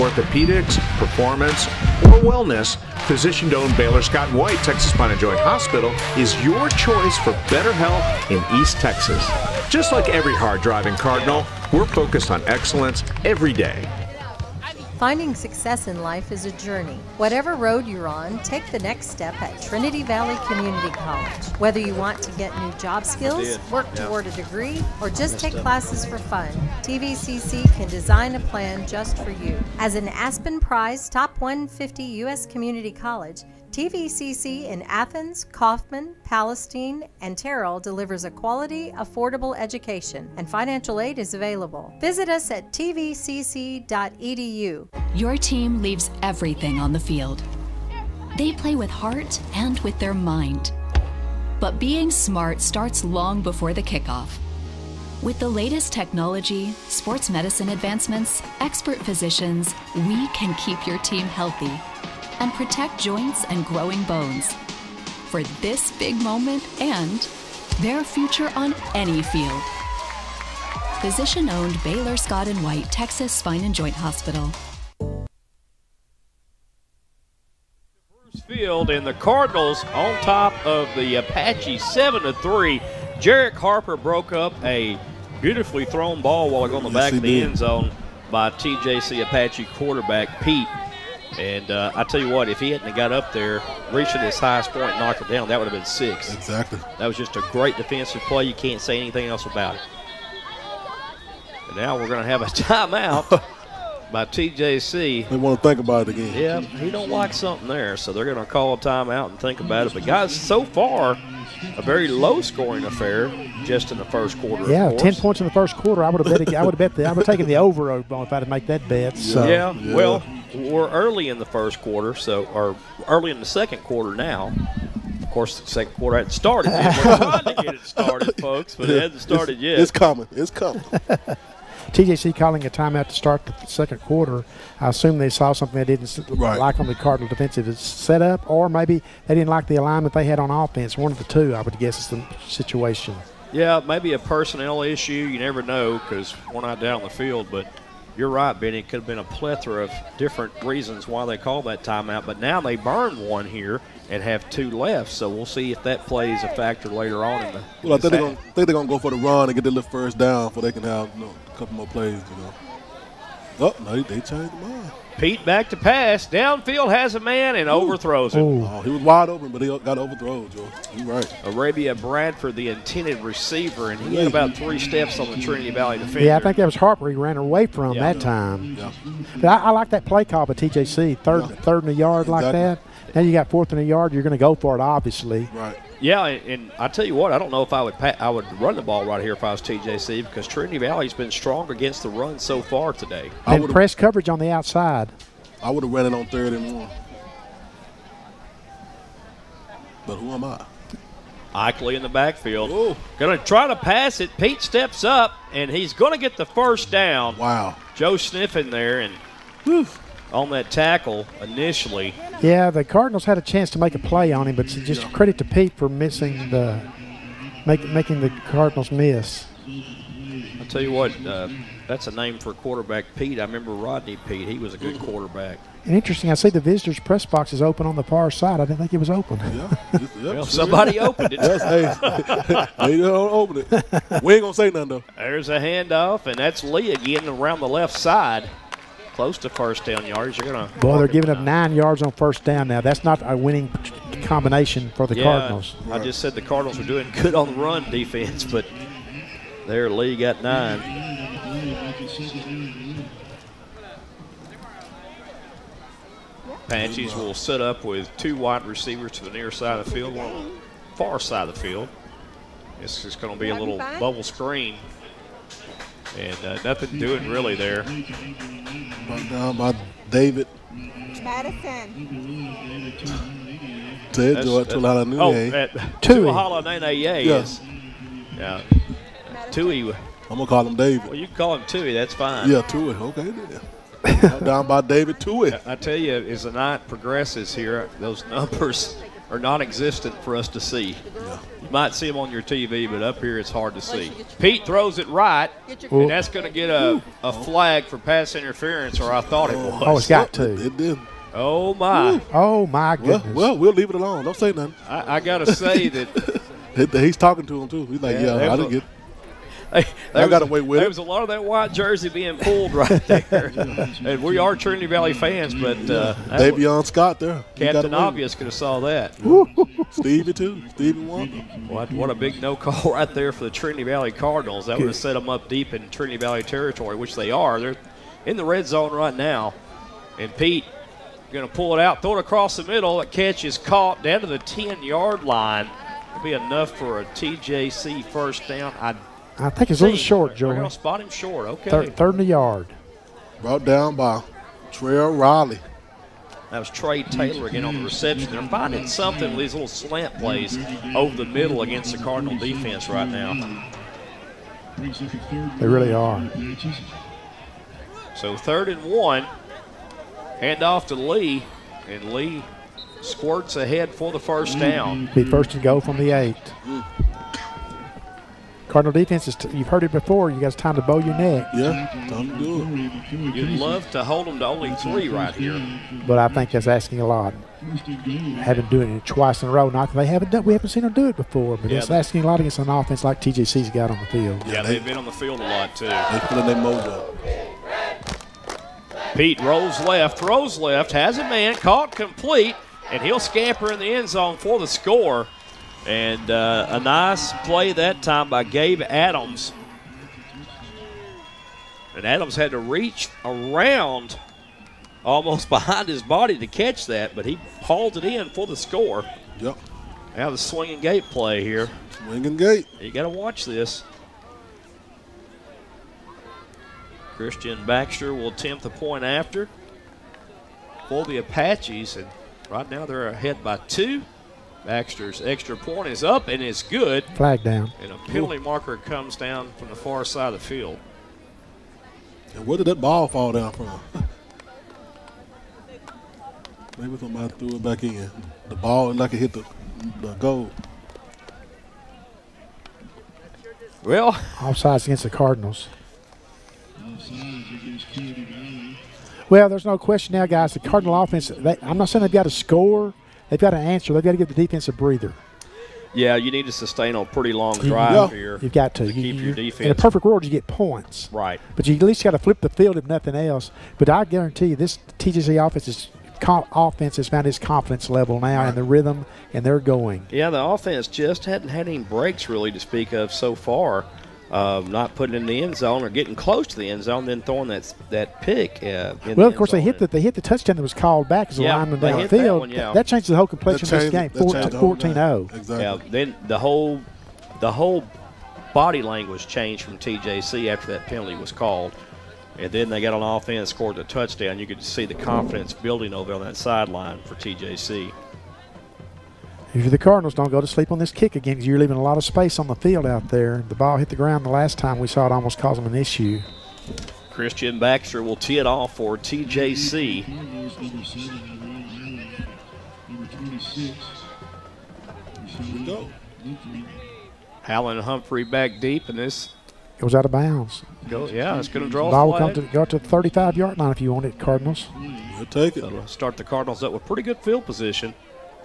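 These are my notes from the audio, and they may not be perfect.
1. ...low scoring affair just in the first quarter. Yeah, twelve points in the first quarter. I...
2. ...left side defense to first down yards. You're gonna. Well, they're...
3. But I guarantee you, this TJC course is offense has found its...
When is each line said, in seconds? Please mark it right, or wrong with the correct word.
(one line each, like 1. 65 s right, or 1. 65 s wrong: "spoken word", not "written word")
1. 112 s wrong: "ten", not "twelve"
2. 237 s wrong: "close", not "defense"
3. 463 s wrong: "offense", not "course".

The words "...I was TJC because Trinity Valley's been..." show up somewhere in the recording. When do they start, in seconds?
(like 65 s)
189 s.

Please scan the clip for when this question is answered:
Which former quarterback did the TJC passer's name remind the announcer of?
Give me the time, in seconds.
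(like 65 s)
223 s.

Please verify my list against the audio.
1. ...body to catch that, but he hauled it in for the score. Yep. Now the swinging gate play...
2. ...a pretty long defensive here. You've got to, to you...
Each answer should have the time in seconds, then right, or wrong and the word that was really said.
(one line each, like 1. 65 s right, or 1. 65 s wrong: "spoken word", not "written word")
1. 406 s right
2. 456 s wrong: "drive", not "defensive".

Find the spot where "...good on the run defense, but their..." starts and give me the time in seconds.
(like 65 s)
247 s.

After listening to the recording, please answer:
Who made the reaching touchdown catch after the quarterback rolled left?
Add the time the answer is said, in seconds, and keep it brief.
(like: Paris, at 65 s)
Gabe Adams, at 398 s.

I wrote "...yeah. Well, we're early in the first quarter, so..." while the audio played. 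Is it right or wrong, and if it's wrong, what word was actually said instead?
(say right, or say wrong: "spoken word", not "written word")
right.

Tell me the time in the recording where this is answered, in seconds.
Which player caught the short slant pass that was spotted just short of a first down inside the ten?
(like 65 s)
346 s.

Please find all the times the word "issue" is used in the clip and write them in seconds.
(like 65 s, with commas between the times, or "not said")
144 s, 505 s.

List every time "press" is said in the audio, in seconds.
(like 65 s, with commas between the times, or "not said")
193 s, 226 s.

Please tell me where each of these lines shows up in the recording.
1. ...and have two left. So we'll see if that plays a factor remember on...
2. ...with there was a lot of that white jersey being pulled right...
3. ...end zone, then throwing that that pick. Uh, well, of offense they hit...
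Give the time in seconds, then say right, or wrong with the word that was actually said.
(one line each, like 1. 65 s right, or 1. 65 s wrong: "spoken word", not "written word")
1. 154 s wrong: "later", not "remember"
2. 310 s right
3. 476 s wrong: "course", not "offense".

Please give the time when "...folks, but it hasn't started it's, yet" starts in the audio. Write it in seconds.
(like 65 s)
128 s.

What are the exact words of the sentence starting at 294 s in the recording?
Pete throws it right, and that's going to get a, a flag for pass interference, or I thought it was.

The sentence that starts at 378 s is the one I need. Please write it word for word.
Haven't doing it twice in a row.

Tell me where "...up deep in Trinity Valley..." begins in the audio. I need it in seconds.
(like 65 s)
325 s.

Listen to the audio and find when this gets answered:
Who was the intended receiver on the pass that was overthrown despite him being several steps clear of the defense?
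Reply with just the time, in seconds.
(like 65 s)
171 s.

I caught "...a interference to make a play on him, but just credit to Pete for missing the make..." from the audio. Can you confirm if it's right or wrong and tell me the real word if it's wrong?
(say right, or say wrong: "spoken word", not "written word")
wrong: "chance", not "interference".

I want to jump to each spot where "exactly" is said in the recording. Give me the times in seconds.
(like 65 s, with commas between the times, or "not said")
96 s, 182 s, 485 s.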